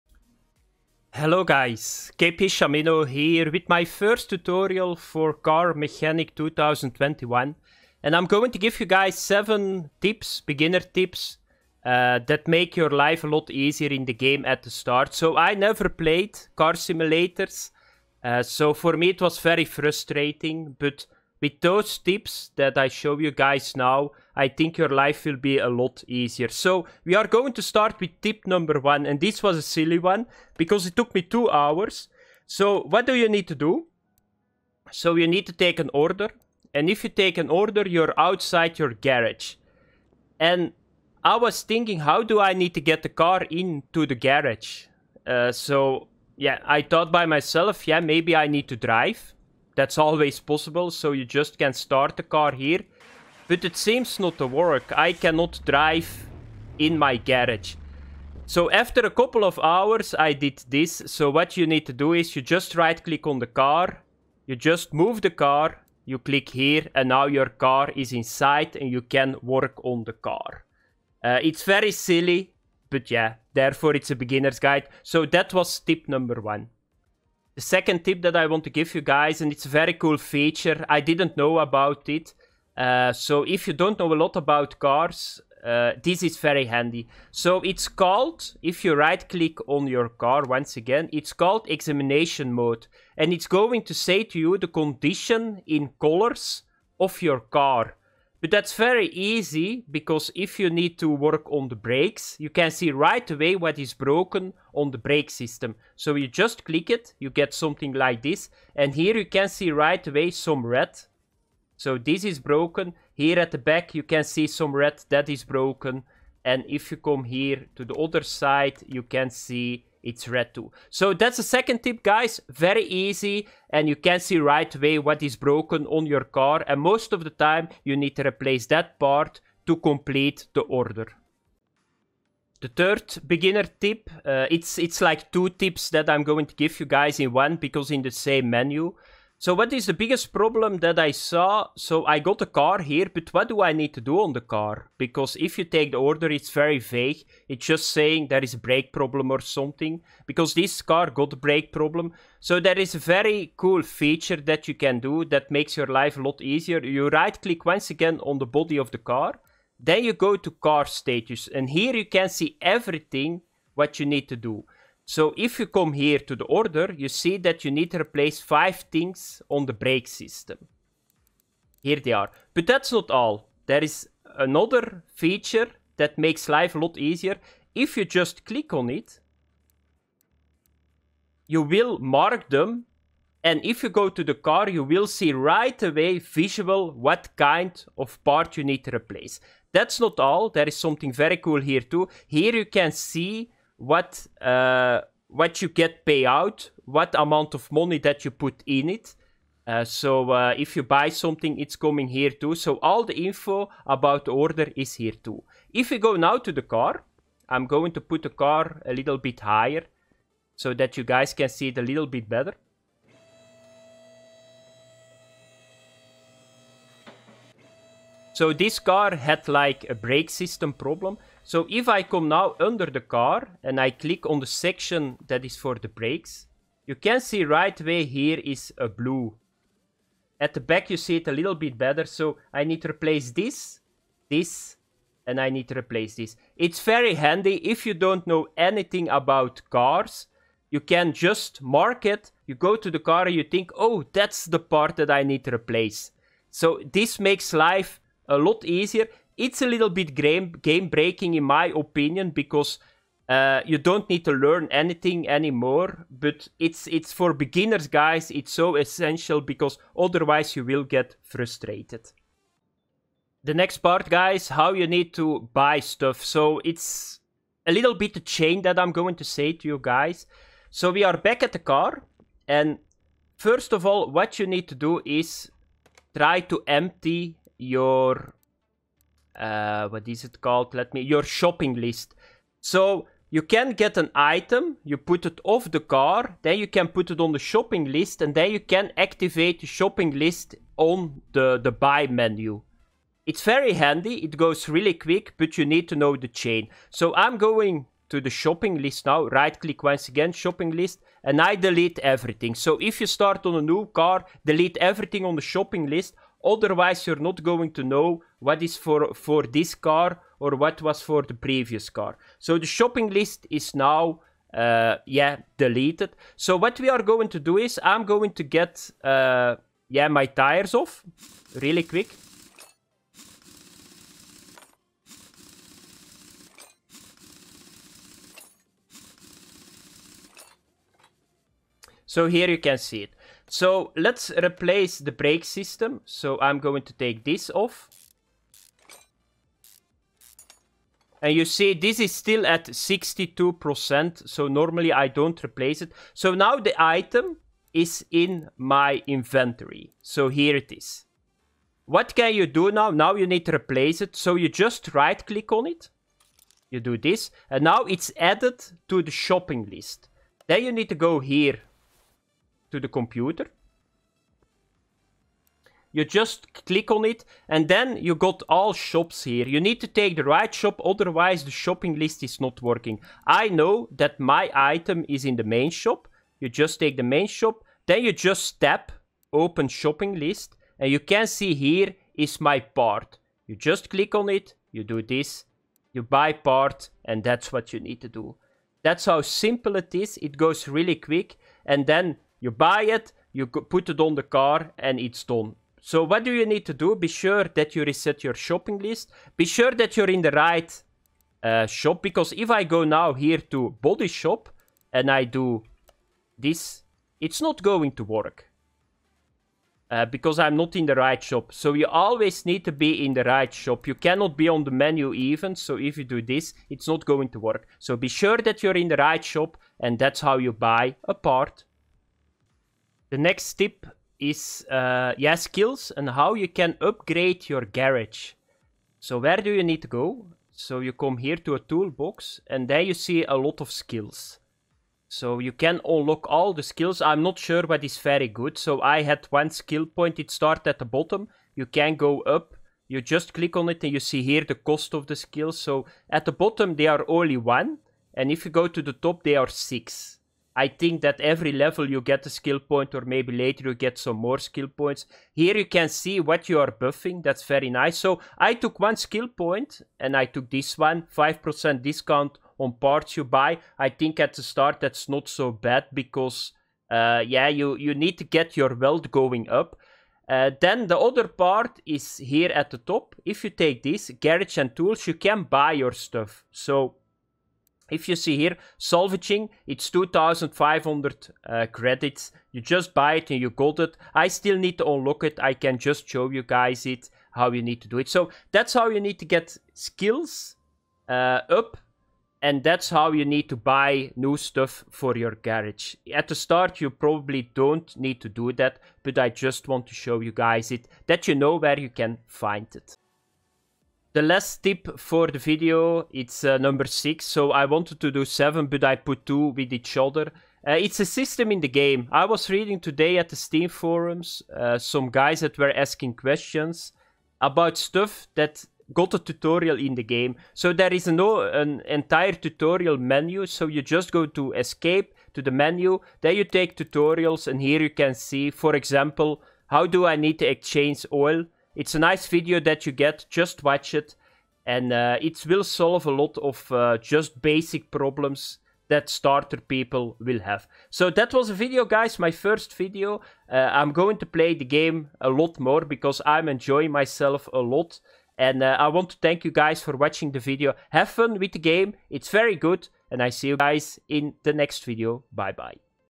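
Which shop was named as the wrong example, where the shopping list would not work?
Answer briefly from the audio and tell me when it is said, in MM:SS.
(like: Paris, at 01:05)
Body Shop, at 06:43.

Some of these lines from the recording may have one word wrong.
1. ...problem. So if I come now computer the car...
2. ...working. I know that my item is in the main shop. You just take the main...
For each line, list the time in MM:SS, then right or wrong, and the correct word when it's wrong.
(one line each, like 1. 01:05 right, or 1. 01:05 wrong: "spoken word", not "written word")
1. 03:40 wrong: "under", not "computer"
2. 06:12 right.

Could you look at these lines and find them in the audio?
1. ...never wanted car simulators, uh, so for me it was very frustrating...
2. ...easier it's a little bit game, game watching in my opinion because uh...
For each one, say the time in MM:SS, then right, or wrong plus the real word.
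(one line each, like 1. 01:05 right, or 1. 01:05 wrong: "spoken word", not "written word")
1. 00:15 wrong: "played", not "wanted"
2. 04:08 wrong: "breaking", not "watching".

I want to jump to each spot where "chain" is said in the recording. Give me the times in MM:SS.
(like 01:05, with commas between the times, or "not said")
04:28, 04:56.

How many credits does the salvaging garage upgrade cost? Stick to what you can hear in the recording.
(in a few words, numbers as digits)
2500.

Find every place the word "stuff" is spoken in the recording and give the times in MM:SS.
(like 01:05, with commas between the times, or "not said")
04:25, 07:55, 08:14, 08:37.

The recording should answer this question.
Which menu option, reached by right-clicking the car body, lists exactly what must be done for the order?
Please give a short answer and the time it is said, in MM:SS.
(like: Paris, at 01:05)
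car status, at 02:40.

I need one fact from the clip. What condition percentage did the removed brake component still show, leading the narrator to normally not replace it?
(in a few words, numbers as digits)
62%.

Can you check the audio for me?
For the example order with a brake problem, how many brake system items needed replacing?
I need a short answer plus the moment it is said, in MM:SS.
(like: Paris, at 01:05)
5, at 02:48.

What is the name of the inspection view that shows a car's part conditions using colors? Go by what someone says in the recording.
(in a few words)
examination mode.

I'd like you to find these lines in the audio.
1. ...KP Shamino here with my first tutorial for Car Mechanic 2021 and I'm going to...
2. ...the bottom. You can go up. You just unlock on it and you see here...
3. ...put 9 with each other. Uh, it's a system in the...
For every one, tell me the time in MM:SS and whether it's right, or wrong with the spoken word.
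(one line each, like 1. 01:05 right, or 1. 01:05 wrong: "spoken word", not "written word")
1. 00:02 right
2. 07:20 wrong: "click", not "unlock"
3. 08:28 wrong: "2", not "9".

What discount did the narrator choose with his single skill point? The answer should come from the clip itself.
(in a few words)
5% on parts.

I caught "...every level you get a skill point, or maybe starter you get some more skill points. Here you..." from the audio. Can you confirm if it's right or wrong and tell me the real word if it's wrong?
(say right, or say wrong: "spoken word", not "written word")
wrong: "later", not "starter".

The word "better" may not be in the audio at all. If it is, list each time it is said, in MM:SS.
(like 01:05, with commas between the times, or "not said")
03:32, 03:51.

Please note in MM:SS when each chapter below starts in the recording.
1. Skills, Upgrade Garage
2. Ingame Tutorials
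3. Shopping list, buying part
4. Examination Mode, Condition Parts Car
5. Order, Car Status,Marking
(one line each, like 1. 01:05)
1. 07:02
2. 08:22
3. 04:22
4. 01:17
5. 02:11.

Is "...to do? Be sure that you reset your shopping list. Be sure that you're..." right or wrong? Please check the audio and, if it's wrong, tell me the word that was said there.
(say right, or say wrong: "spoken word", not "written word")
right.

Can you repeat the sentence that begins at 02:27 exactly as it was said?
It's just saying there is a brake problem or something.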